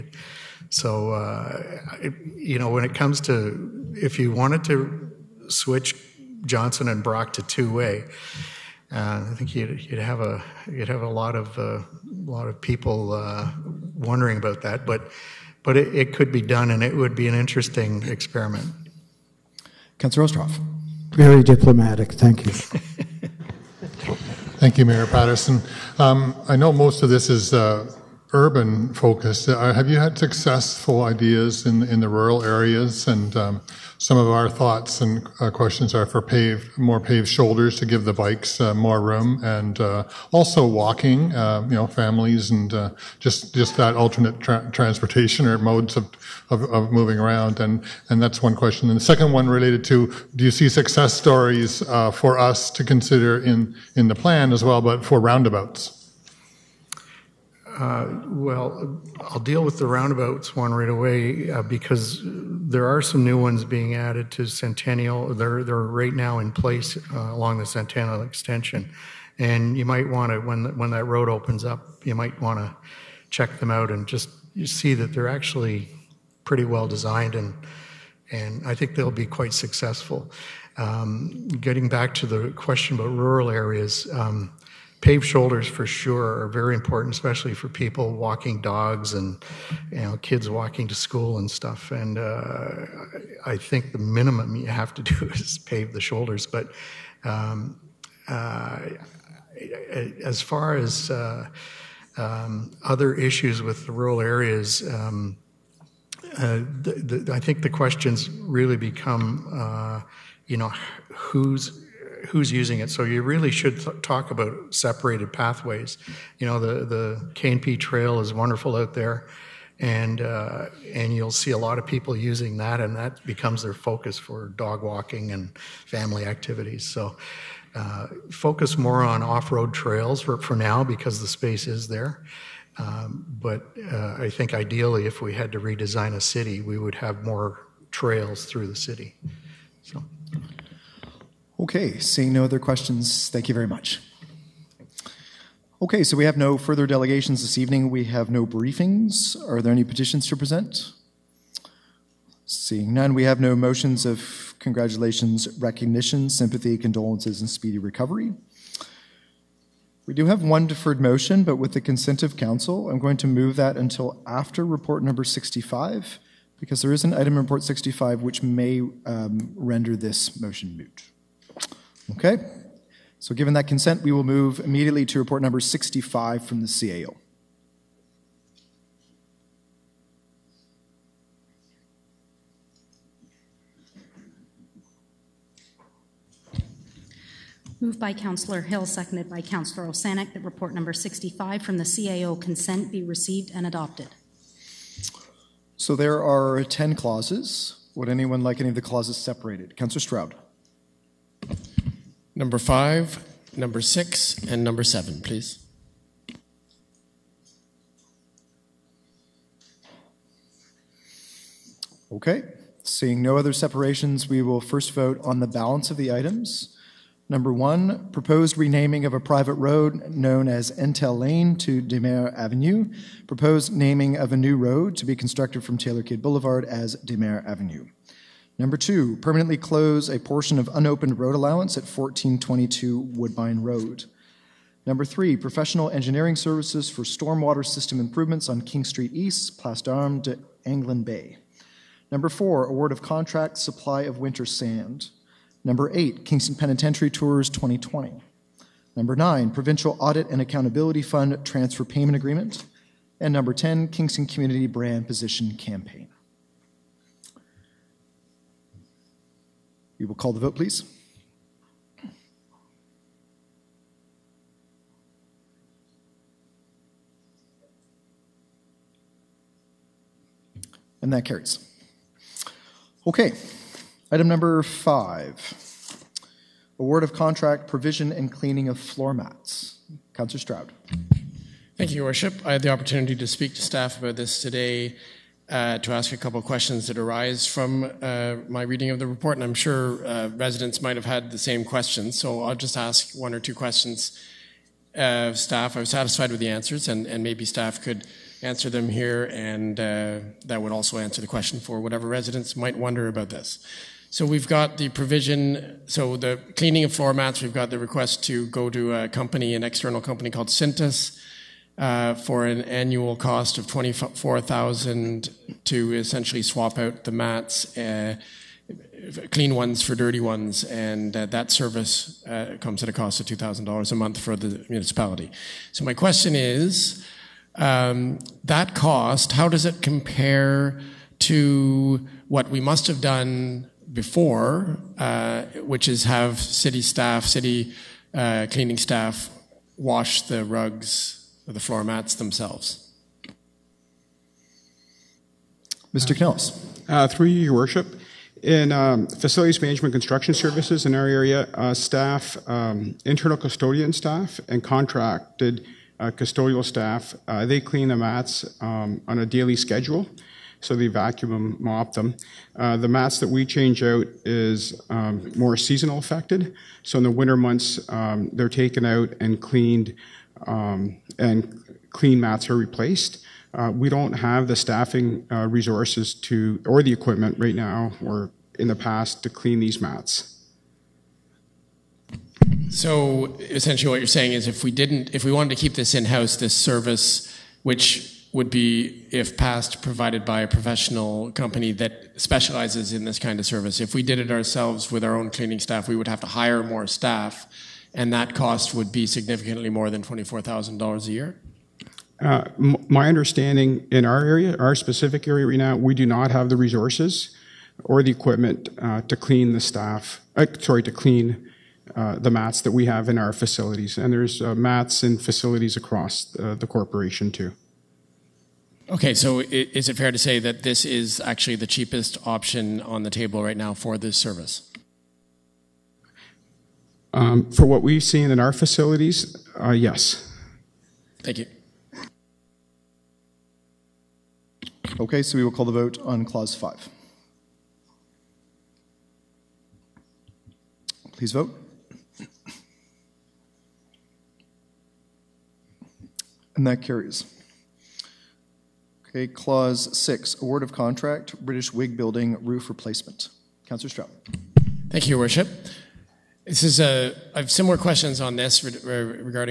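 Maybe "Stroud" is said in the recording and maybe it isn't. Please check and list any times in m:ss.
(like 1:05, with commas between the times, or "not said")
3:19, 4:40, 7:33.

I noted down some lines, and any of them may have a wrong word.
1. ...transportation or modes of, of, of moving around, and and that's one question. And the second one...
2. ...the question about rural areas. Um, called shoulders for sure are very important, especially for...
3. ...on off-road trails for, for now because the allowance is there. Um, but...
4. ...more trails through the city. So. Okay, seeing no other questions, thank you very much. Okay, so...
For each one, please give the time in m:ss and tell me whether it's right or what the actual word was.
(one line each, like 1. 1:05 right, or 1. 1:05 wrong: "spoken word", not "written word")
1. 0:44 right
2. 1:22 wrong: "paved", not "called"
3. 2:09 wrong: "space", not "allowance"
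4. 2:17 right.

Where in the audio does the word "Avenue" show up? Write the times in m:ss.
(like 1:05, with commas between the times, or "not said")
3:42, 3:47.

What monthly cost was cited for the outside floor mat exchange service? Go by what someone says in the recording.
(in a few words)
$2,000.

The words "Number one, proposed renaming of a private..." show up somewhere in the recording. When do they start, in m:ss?
3:37.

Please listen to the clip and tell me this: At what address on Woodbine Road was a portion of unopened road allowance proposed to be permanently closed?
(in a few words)
1422.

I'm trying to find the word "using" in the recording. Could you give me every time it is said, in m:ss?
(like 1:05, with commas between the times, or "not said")
1:52, 2:02.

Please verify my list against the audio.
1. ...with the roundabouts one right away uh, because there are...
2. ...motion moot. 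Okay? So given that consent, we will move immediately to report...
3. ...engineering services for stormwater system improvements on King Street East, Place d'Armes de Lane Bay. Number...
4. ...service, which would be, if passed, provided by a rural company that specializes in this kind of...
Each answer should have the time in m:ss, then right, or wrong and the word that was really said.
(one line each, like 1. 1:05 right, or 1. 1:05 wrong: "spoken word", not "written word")
1. 0:59 right
2. 2:50 right
3. 3:55 wrong: "Anglin", not "Lane"
4. 6:26 wrong: "professional", not "rural".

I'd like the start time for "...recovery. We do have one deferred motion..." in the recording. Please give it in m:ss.
2:37.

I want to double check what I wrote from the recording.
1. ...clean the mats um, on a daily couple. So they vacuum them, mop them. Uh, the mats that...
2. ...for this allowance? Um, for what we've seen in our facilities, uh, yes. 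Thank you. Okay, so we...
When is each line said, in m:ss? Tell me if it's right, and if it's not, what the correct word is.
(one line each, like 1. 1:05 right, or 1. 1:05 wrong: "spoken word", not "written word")
1. 5:57 wrong: "schedule", not "couple"
2. 7:03 wrong: "service", not "allowance".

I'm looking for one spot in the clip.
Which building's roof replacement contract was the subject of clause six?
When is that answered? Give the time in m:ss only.
7:31.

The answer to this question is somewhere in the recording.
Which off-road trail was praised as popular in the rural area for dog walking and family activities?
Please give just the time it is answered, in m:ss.
1:57.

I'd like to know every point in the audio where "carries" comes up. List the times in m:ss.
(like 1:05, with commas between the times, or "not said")
4:31, 7:26.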